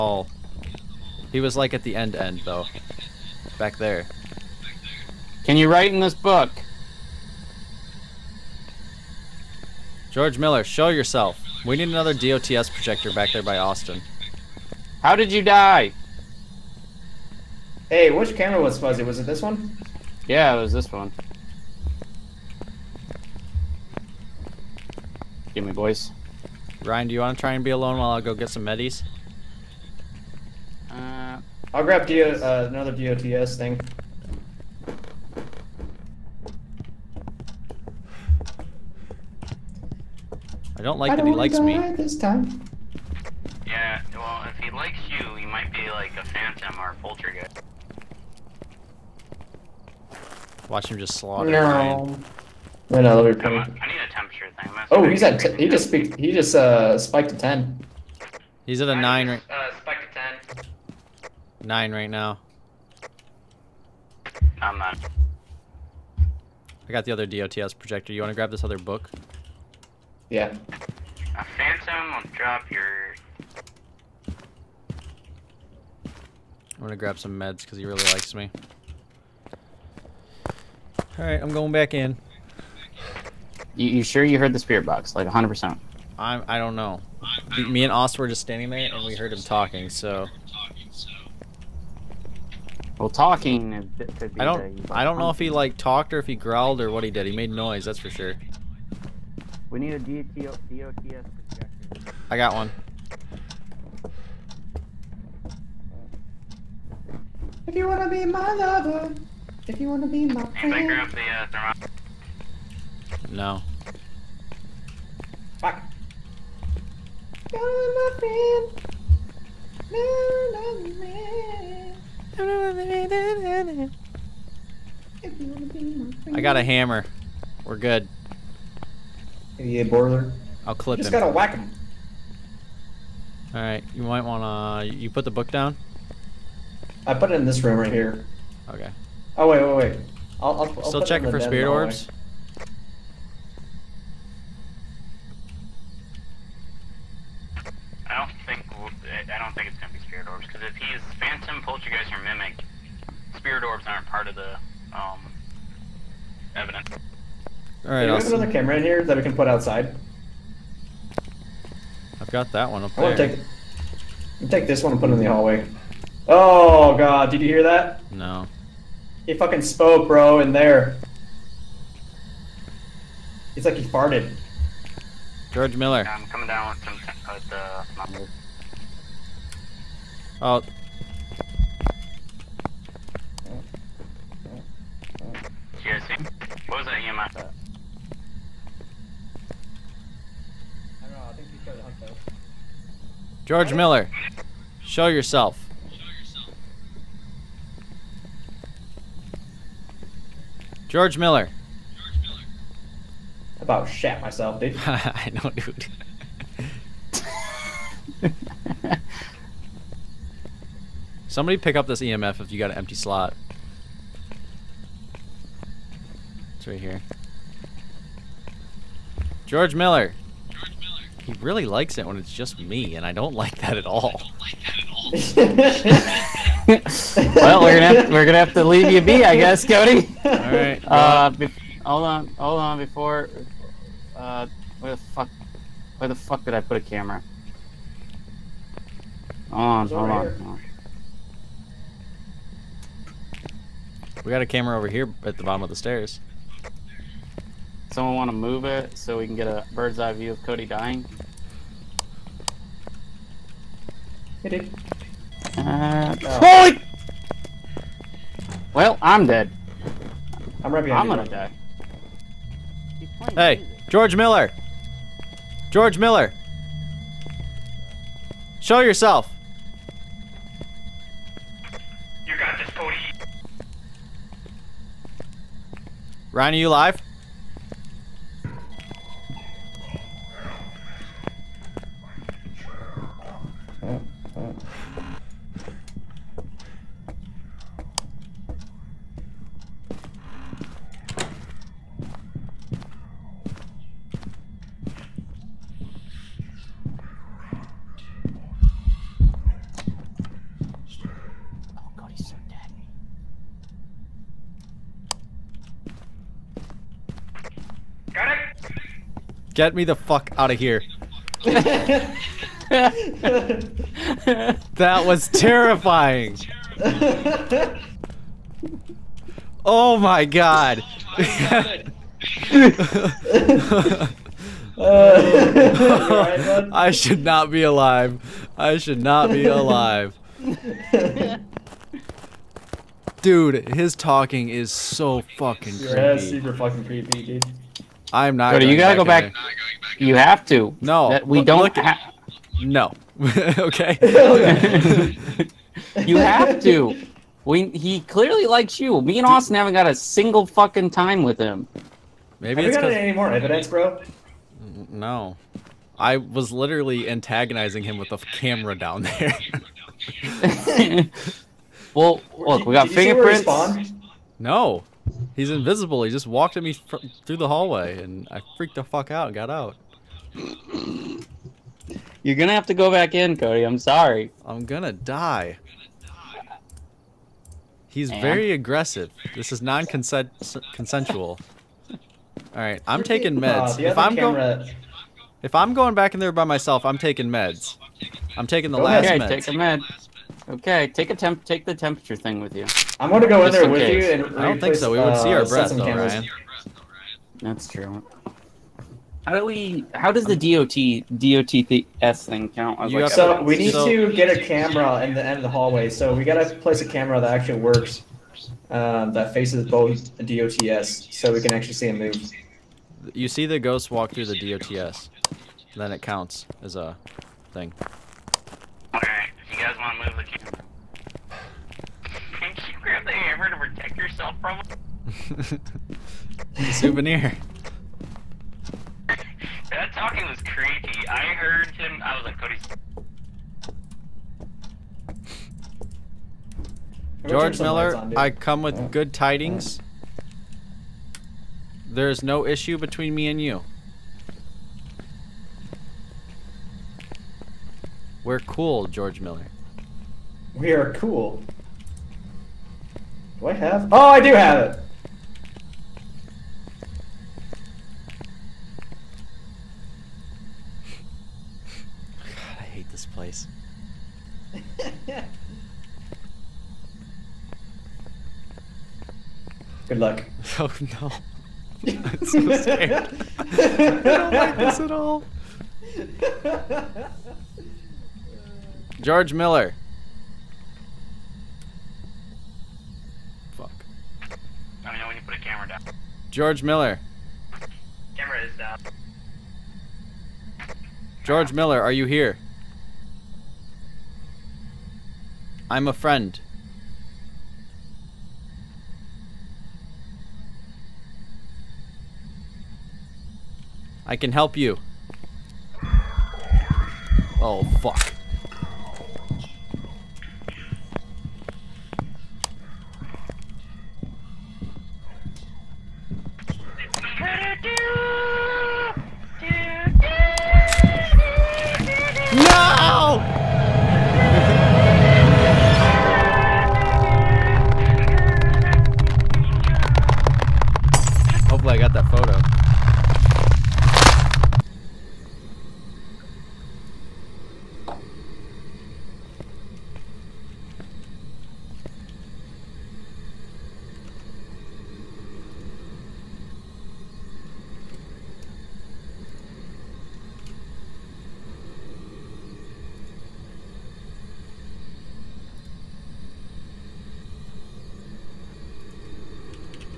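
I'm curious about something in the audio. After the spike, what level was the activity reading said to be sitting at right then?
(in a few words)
9.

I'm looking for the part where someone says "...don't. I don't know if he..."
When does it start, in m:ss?
1:34.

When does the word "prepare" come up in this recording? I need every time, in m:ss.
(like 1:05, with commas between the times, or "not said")
not said.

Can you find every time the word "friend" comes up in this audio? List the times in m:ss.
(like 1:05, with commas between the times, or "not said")
1:50, 8:15.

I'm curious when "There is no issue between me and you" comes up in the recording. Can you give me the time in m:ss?
7:21.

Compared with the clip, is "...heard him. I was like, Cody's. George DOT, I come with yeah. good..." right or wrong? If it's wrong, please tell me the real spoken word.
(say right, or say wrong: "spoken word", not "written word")
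wrong: "Miller", not "DOT".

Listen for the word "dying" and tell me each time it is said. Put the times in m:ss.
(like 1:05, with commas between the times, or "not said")
4:10.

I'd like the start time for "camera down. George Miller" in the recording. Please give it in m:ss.
8:05.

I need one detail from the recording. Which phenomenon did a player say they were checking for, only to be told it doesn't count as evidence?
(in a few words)
spirit orbs.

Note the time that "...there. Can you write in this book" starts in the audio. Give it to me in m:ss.
0:03.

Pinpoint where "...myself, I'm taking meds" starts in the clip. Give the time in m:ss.
6:26.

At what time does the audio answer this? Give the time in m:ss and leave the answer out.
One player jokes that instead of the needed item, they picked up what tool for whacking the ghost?
2:06.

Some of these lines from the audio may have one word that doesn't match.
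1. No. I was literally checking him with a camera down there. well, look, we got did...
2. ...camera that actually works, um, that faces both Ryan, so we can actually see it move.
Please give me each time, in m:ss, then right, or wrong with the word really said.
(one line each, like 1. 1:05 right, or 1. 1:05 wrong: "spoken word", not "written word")
1. 5:54 wrong: "antagonizing", not "checking"
2. 6:46 wrong: "DOTS", not "Ryan".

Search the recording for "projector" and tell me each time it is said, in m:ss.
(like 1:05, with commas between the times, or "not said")
0:12, 1:07, 1:40.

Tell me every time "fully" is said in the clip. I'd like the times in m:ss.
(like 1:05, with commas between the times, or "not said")
not said.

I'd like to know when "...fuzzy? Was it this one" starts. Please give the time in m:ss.
0:18.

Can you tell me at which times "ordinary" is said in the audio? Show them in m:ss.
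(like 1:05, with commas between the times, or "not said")
not said.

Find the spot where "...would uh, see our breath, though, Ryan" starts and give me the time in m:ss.
6:34.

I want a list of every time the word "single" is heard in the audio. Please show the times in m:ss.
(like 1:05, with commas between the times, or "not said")
5:49.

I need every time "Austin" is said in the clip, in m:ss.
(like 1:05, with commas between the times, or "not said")
0:13, 1:27, 5:49.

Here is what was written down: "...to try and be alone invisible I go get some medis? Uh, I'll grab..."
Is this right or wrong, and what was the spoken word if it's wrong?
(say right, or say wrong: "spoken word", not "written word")
wrong: "while", not "invisible".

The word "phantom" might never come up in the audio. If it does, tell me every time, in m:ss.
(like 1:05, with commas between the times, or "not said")
0:46, 1:11.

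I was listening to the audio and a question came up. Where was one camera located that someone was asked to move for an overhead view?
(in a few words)
bottom of the stairs.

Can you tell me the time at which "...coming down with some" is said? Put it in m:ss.
2:56.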